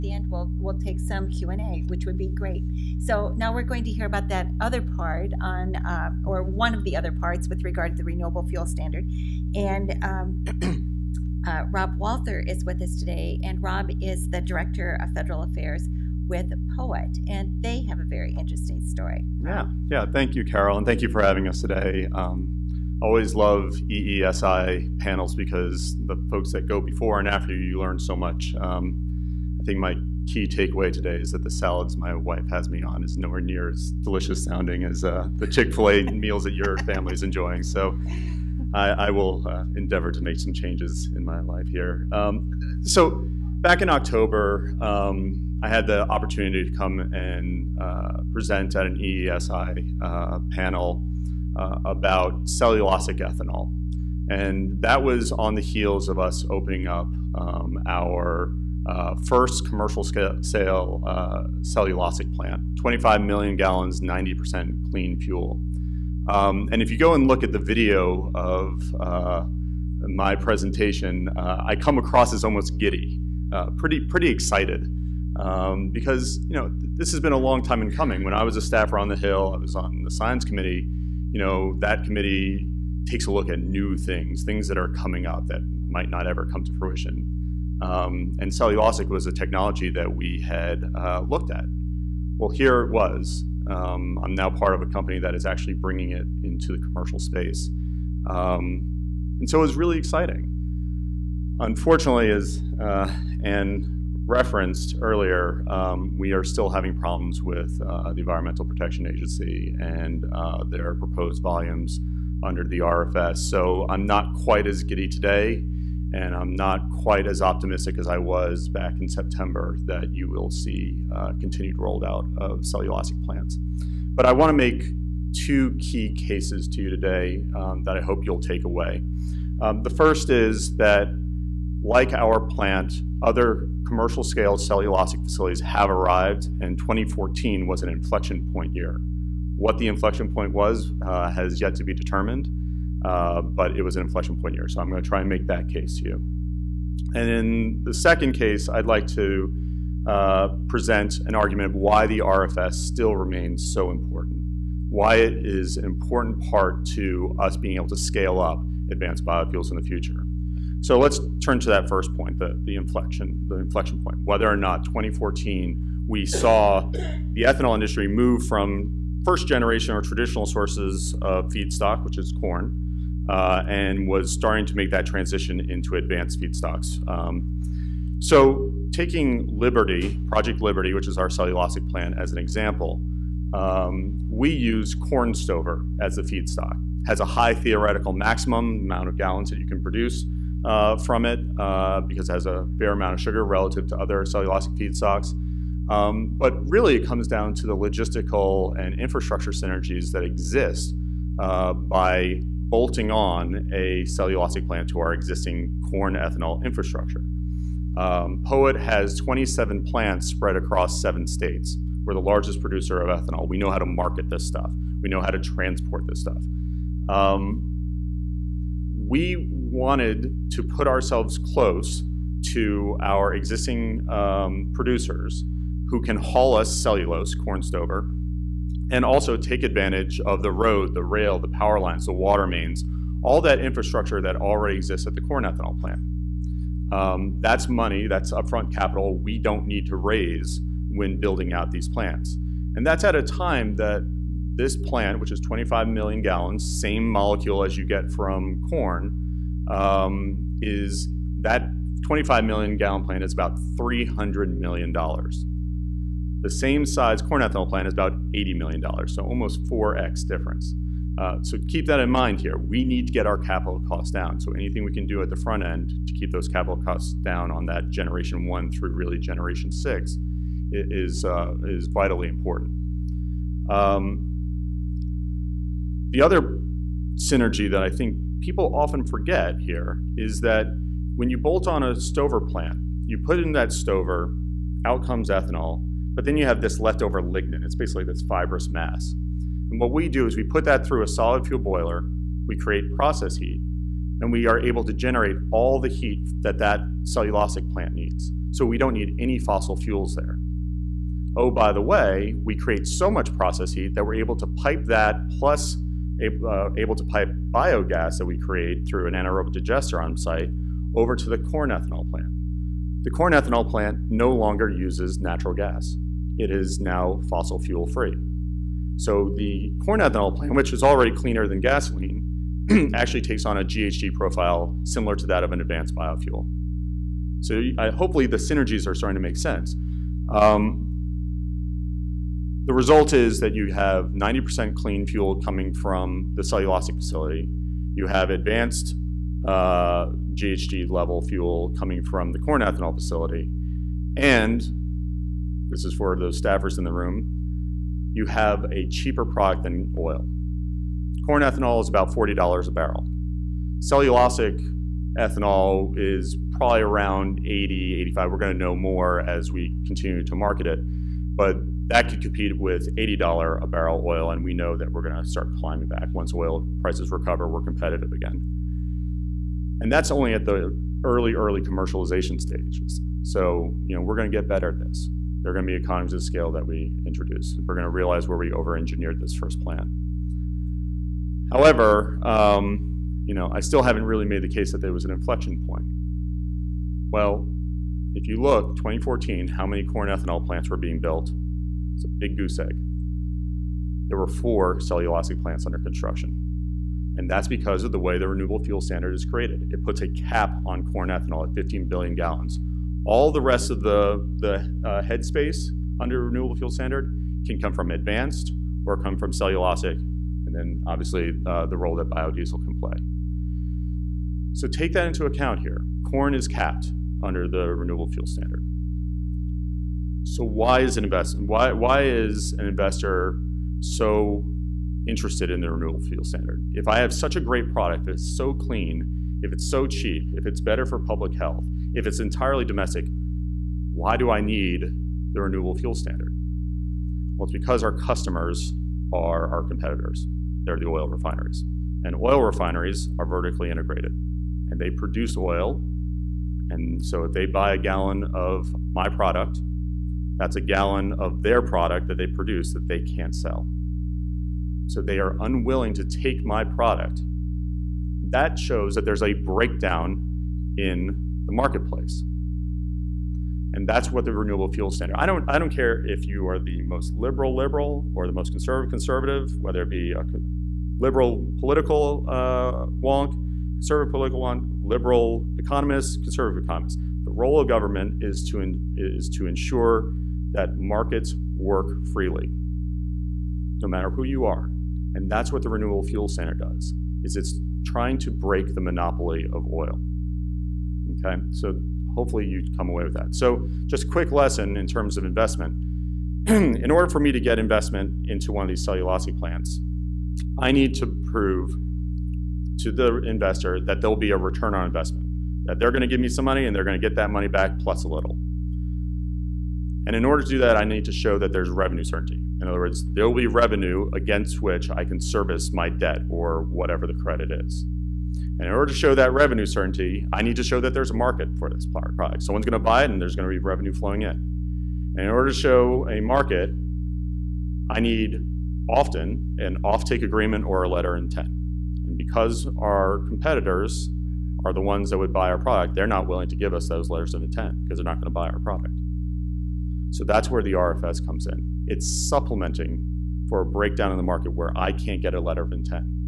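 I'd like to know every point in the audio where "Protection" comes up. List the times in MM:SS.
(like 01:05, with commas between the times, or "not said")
01:48.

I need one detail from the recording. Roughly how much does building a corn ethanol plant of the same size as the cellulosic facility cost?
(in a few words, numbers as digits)
$80 million.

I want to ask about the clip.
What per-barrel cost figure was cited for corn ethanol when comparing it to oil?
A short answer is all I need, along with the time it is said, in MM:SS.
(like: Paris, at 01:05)
$40, at 05:52.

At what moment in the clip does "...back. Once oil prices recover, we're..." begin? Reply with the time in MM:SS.
06:05.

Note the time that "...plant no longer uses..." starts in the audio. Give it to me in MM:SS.
05:13.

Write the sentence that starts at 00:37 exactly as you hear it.
So I, I will uh, endeavor to make some changes in my life here.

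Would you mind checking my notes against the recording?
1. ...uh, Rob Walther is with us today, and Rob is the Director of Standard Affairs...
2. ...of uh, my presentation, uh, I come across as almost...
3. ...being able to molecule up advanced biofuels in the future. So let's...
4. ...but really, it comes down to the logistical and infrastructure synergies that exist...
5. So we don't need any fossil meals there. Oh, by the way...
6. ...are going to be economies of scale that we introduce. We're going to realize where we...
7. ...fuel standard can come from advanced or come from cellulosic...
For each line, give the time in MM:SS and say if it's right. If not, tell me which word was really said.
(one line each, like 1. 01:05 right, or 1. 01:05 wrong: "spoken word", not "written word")
1. 00:11 wrong: "Federal", not "Standard"
2. 01:08 right
3. 02:37 wrong: "scale", not "molecule"
4. 03:16 right
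5. 04:58 wrong: "fuels", not "meals"
6. 06:15 right
7. 06:46 right.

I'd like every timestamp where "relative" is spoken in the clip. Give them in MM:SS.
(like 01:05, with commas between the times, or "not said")
03:13.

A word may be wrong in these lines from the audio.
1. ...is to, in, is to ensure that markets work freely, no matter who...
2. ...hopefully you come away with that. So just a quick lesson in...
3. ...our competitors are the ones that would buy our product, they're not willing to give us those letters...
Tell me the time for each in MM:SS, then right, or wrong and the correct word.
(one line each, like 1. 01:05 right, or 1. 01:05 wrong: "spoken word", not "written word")
1. 07:58 right
2. 08:12 right
3. 08:52 right.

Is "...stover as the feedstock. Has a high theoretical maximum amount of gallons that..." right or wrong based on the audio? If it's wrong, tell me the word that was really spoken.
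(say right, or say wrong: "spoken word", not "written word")
right.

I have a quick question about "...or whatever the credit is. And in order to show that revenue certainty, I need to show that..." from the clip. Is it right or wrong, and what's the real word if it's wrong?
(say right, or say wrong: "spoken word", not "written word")
right.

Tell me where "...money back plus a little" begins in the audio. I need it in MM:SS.
08:27.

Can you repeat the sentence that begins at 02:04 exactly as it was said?
But I want to make two key cases to you today um, that I hope you'll take away.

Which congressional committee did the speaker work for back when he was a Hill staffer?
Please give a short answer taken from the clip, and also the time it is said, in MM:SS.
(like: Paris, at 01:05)
science committee, at 01:20.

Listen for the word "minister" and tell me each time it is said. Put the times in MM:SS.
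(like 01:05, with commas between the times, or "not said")
not said.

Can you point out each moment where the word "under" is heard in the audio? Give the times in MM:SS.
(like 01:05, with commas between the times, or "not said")
01:52, 06:35, 06:45, 06:57.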